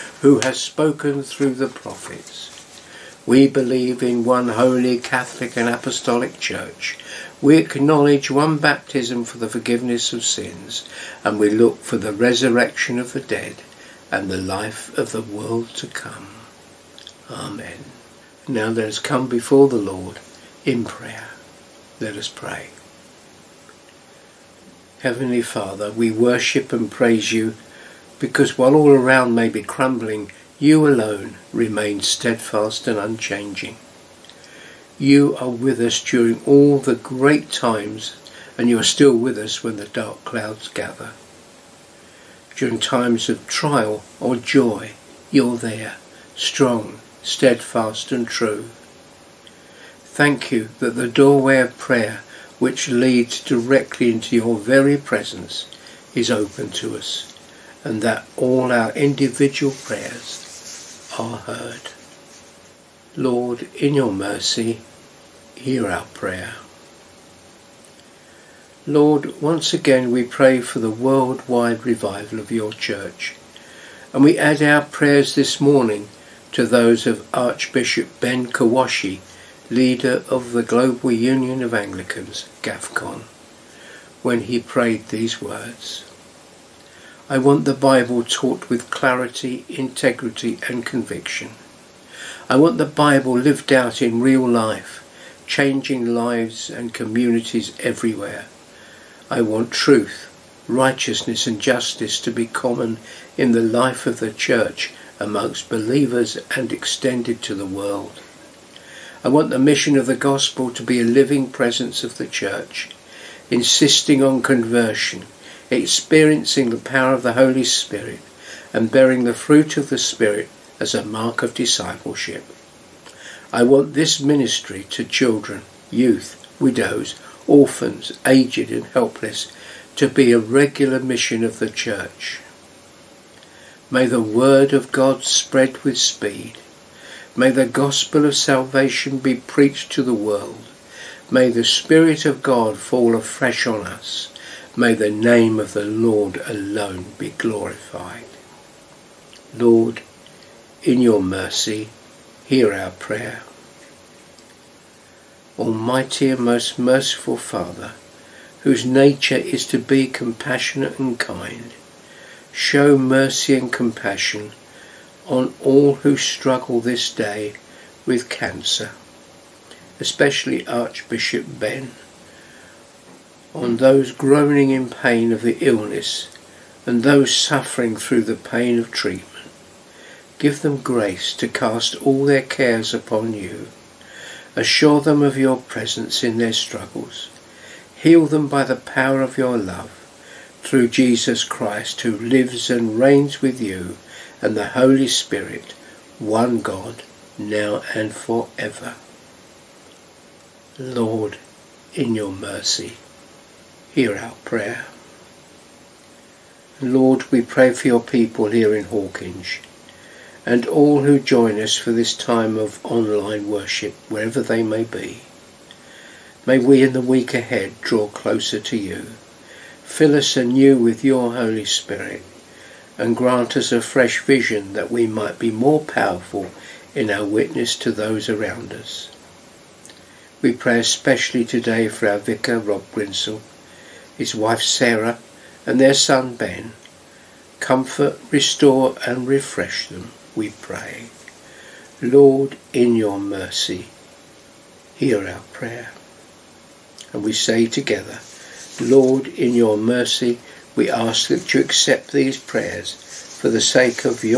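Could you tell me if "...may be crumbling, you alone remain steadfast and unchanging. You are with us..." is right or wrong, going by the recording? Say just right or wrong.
right.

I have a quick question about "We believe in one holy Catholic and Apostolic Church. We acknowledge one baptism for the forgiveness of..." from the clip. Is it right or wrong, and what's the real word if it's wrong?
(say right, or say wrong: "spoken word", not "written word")
right.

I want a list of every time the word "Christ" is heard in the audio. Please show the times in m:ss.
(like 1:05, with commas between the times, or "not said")
3:11.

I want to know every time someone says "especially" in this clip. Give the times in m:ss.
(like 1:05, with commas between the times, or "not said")
2:49, 3:50.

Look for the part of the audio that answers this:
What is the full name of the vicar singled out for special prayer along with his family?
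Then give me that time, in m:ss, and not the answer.
3:52.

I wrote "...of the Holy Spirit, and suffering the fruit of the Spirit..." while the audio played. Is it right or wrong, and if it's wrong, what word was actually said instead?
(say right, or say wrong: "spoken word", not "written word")
wrong: "bearing", not "suffering".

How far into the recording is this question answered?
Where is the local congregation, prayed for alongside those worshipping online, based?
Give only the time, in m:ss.
3:28.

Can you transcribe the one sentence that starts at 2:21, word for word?
May the Spirit of God fall afresh on us.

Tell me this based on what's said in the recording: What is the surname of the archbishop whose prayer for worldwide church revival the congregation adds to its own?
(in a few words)
Kwashi.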